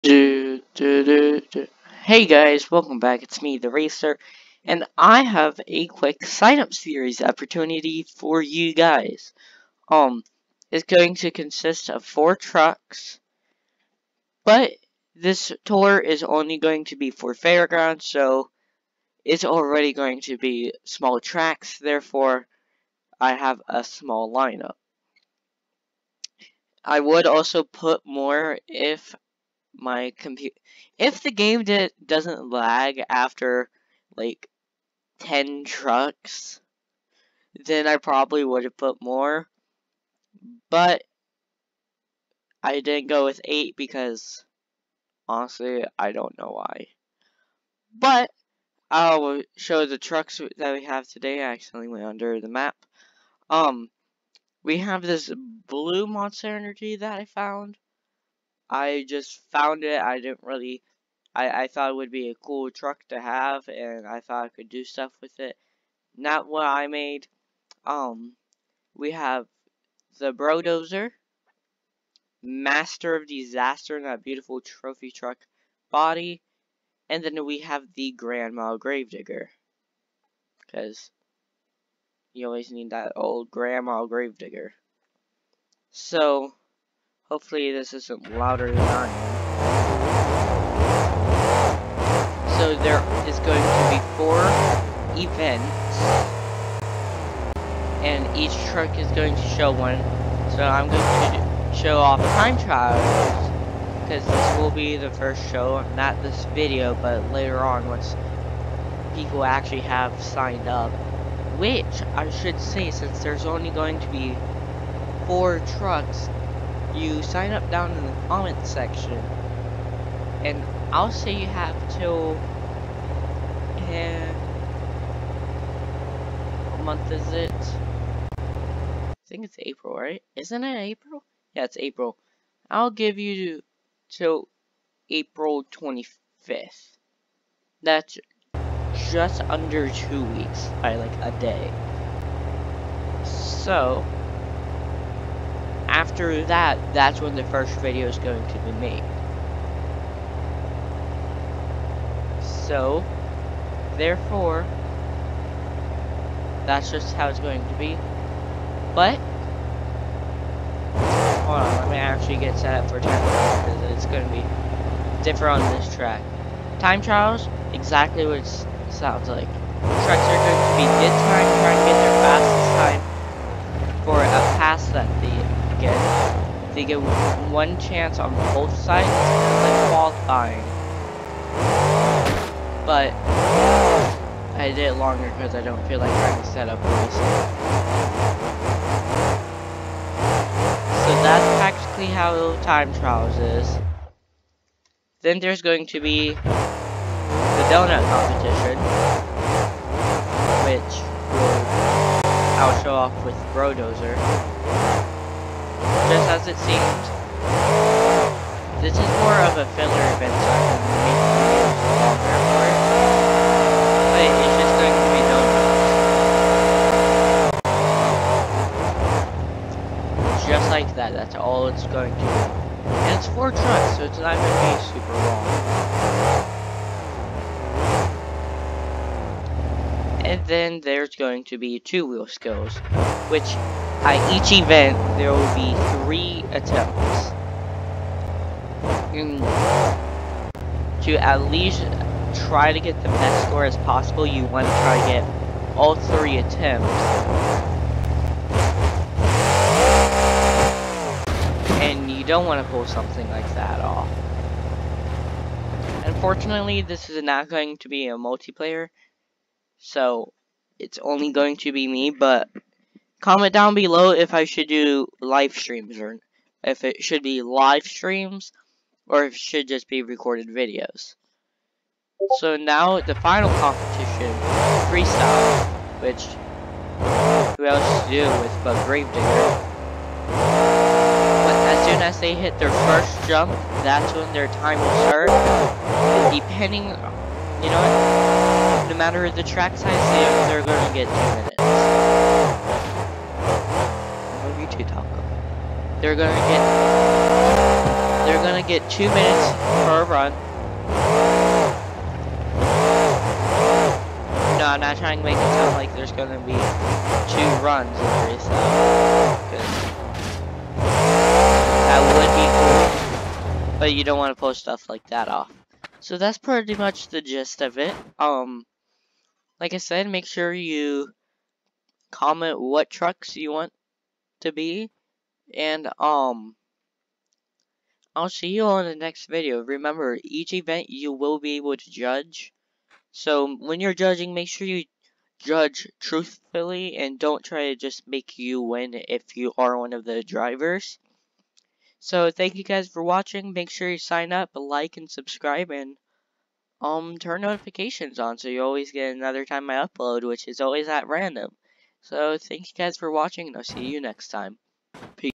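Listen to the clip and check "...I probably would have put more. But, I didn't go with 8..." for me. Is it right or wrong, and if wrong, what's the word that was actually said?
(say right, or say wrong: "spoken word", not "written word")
right.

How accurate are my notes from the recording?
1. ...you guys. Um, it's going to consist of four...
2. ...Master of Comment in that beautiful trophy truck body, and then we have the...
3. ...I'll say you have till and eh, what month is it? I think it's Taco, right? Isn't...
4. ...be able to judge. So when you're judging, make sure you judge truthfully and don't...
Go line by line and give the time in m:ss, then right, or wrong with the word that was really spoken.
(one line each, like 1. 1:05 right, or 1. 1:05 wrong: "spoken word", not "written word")
1. 0:08 right
2. 1:12 wrong: "Disaster", not "Comment"
3. 2:00 wrong: "April", not "Taco"
4. 5:31 right.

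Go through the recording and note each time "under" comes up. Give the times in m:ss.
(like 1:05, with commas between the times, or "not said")
0:52, 2:19.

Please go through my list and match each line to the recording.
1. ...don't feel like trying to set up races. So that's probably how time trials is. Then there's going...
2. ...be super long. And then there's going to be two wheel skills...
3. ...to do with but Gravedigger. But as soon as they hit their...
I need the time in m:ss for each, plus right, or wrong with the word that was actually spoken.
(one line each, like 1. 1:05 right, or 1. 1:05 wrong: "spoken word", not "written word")
1. 3:05 wrong: "practically", not "probably"
2. 3:44 right
3. 4:38 right.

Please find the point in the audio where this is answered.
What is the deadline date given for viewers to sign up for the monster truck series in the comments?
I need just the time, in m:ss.
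2:15.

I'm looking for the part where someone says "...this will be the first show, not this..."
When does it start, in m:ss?
1:44.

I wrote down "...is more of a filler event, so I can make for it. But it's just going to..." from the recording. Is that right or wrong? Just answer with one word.
right.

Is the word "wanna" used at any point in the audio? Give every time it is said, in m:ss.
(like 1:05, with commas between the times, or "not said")
5:14.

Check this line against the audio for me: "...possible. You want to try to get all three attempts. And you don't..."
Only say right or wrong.
right.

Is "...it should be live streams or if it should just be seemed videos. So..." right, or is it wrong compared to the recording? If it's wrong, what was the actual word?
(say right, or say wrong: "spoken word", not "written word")
wrong: "recorded", not "seemed".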